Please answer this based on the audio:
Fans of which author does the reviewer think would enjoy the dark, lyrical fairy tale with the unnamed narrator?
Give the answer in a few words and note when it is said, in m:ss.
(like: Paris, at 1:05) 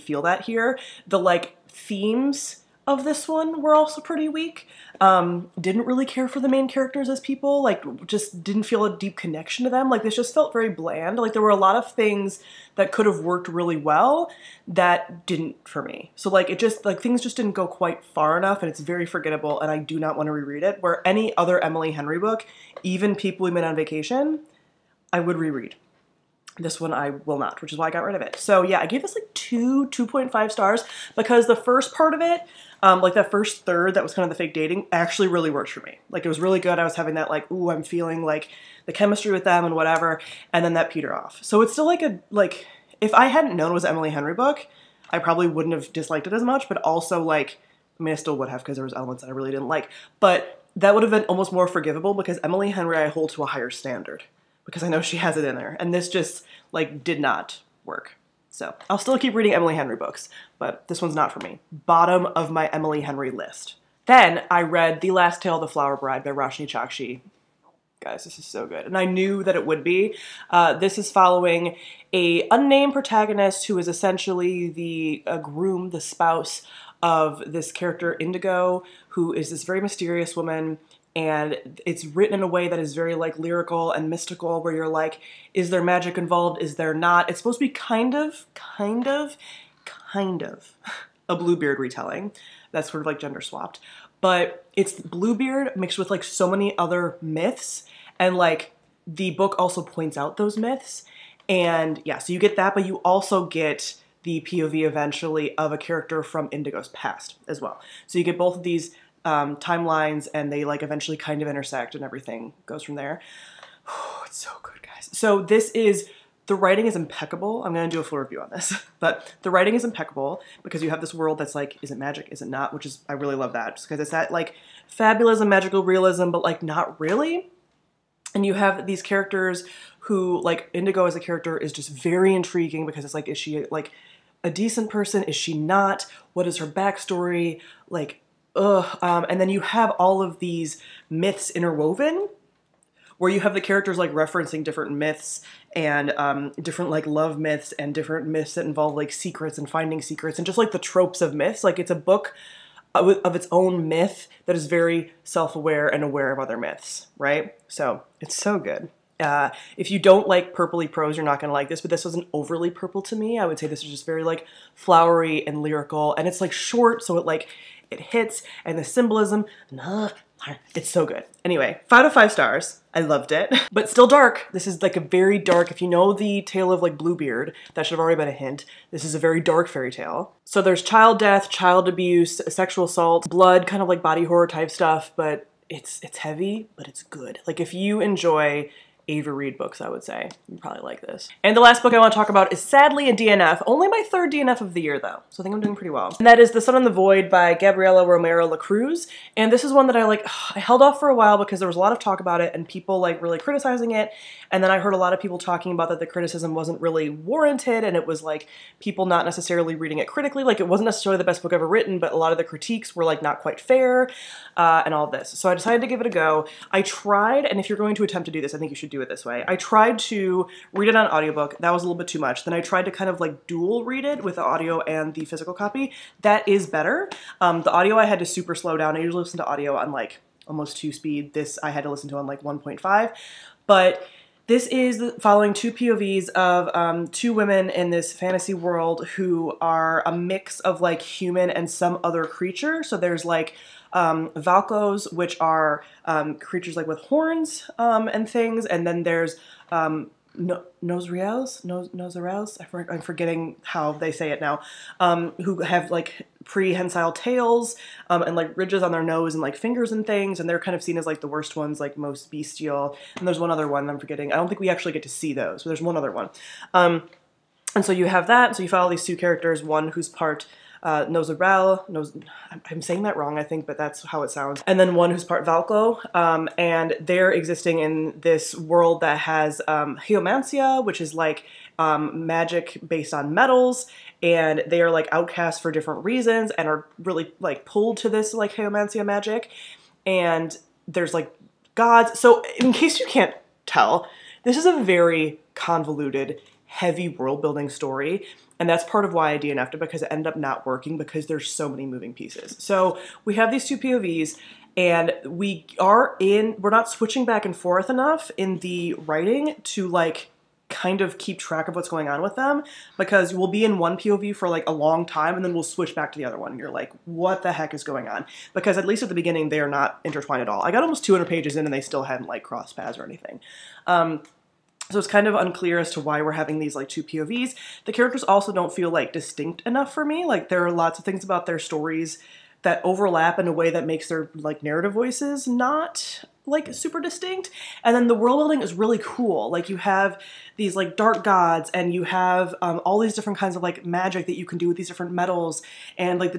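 Ava Reid, at 3:09.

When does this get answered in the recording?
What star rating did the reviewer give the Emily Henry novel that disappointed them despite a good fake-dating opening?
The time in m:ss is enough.
0:29.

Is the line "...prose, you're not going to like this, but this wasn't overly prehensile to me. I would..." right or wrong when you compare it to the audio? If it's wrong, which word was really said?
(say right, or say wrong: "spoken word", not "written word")
wrong: "purple", not "prehensile".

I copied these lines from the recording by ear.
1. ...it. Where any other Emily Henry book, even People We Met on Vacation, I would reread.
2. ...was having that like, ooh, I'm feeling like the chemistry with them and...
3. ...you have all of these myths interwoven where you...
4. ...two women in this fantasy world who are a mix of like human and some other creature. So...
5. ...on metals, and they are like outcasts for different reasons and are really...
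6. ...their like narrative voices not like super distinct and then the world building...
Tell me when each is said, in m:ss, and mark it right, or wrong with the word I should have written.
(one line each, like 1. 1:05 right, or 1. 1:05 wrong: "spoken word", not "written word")
1. 0:20 right
2. 0:36 right
3. 2:19 right
4. 3:57 right
5. 4:43 right
6. 5:34 right.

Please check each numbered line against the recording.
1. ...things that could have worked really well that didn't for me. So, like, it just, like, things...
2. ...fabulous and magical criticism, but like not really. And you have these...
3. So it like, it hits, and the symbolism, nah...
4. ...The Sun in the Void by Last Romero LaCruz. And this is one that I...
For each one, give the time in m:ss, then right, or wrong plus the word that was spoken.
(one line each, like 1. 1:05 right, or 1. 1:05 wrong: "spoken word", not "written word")
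1. 0:11 right
2. 2:04 wrong: "realism", not "criticism"
3. 2:47 right
4. 3:16 wrong: "Gabriela", not "Last".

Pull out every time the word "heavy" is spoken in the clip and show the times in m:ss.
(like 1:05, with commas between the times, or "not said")
3:06, 4:56.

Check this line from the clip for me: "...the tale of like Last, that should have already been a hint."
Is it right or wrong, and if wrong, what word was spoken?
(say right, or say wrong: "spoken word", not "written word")
wrong: "Bluebeard", not "Last".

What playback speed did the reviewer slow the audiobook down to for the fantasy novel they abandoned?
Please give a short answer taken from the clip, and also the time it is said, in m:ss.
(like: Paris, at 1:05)
1.5, at 3:52.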